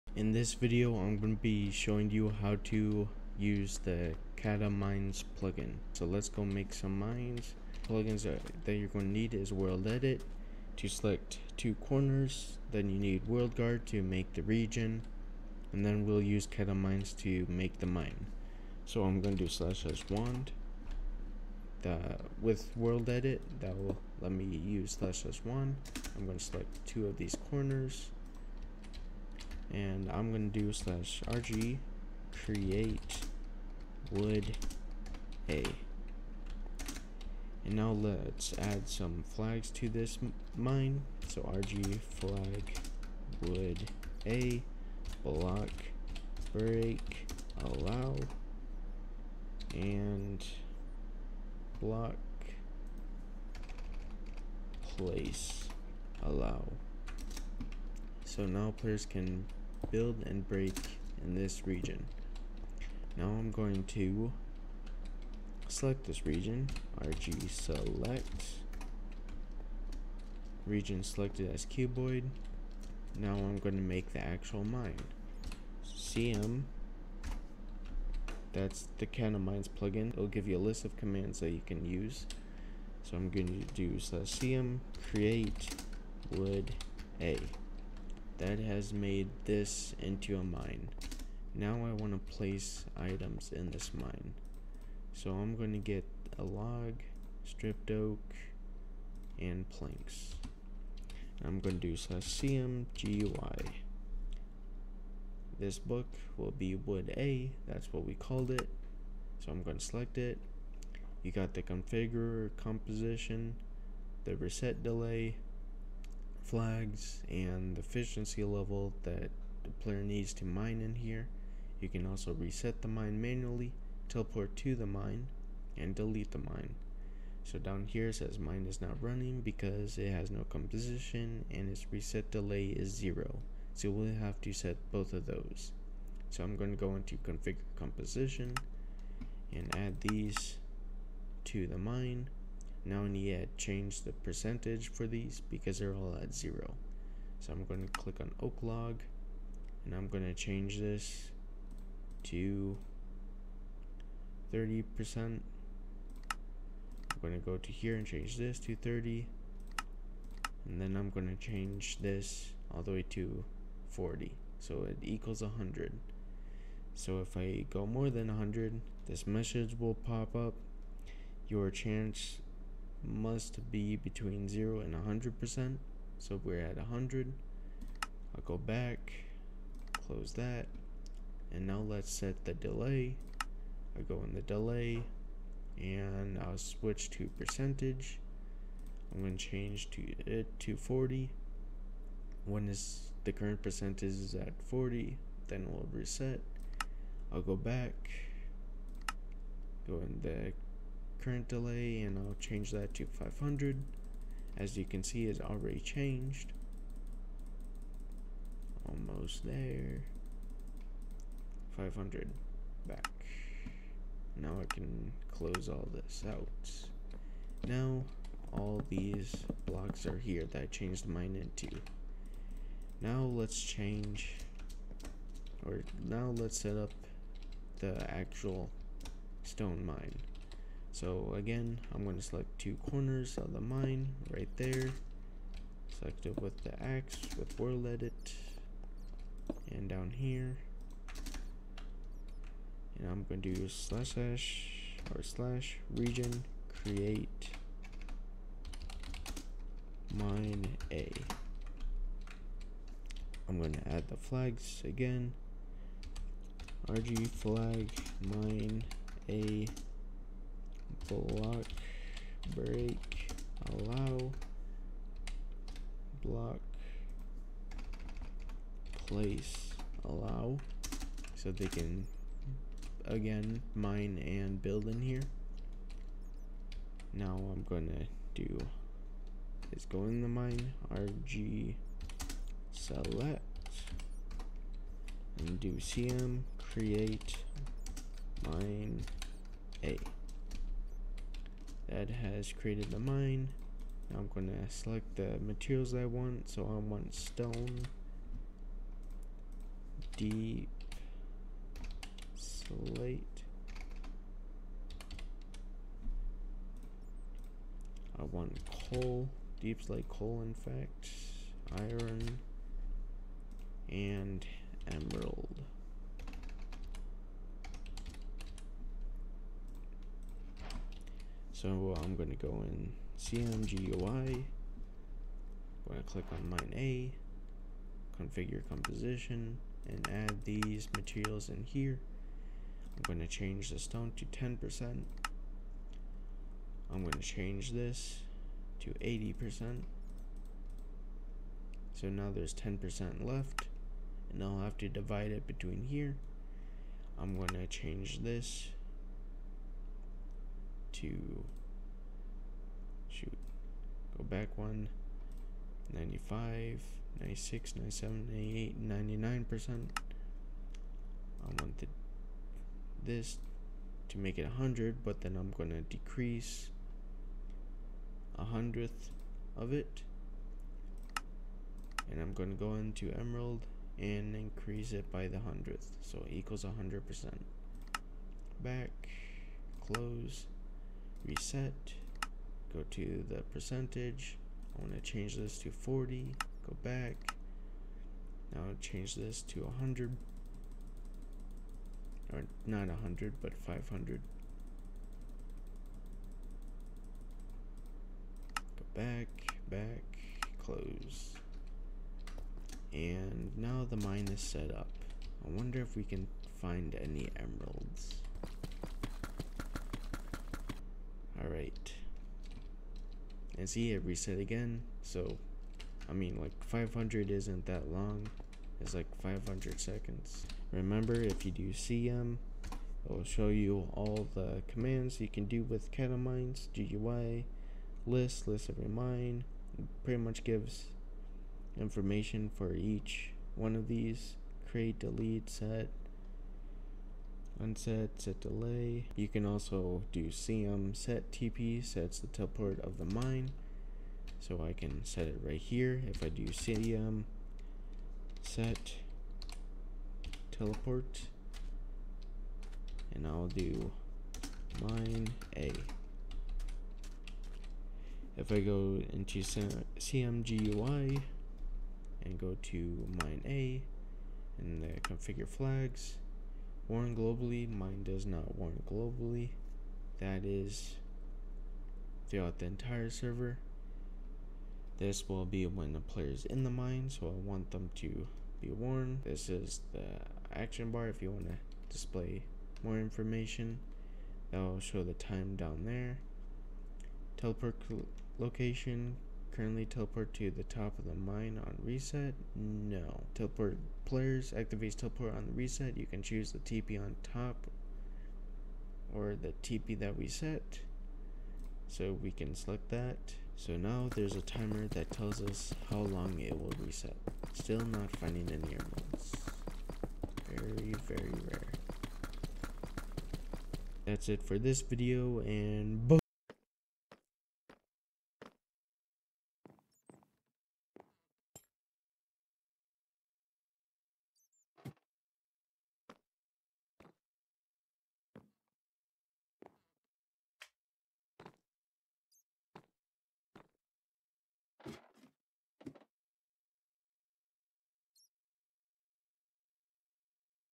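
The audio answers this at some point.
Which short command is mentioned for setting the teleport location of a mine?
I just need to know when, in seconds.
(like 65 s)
440 s.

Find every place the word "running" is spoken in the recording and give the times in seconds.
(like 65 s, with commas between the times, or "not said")
129 s.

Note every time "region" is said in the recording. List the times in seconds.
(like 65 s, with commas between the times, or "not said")
14 s, 61 s, 66 s, 70 s, 245 s.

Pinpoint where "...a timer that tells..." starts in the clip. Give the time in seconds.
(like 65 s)
504 s.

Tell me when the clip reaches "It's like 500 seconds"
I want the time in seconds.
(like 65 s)
418 s.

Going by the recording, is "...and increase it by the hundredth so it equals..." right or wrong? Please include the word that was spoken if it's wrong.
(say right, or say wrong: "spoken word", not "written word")
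right.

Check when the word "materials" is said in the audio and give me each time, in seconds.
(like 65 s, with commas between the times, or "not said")
295 s, 330 s.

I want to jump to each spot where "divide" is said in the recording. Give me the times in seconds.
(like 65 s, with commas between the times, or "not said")
344 s.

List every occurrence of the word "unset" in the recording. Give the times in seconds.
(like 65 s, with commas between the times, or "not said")
437 s.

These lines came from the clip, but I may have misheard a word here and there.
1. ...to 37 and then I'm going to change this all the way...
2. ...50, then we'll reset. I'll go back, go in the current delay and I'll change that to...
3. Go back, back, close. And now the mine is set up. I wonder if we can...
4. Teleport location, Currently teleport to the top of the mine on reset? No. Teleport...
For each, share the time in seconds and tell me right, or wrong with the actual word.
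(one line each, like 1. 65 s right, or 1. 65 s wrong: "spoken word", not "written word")
1. 158 s wrong: "30", not "37"
2. 194 s wrong: "40", not "50"
3. 398 s right
4. 487 s right.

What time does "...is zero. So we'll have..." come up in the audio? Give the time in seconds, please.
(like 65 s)
132 s.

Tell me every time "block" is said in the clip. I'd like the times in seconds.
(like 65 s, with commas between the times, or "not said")
45 s, 51 s, 219 s, 261 s, 266 s.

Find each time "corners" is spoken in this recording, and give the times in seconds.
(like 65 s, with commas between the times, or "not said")
11 s, 27 s, 232 s.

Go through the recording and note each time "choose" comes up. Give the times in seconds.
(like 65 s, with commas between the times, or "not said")
496 s.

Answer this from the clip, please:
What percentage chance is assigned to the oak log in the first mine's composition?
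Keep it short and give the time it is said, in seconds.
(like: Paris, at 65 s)
30, at 154 s.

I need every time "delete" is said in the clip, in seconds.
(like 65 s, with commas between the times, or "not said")
125 s, 434 s.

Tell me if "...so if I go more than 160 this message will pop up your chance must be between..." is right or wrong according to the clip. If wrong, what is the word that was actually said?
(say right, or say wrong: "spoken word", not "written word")
wrong: "100", not "160".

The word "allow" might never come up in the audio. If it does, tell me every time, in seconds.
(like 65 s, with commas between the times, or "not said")
47 s, 56 s, 263 s, 270 s.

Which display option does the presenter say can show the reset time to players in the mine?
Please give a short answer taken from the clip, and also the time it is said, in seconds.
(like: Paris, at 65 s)
action bar, at 480 s.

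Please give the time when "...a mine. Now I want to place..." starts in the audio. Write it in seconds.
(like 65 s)
90 s.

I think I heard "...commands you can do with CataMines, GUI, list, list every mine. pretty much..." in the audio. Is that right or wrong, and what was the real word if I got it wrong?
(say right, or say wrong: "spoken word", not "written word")
right.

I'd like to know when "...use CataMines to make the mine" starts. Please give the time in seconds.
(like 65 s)
16 s.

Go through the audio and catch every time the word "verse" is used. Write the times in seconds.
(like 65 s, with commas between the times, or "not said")
not said.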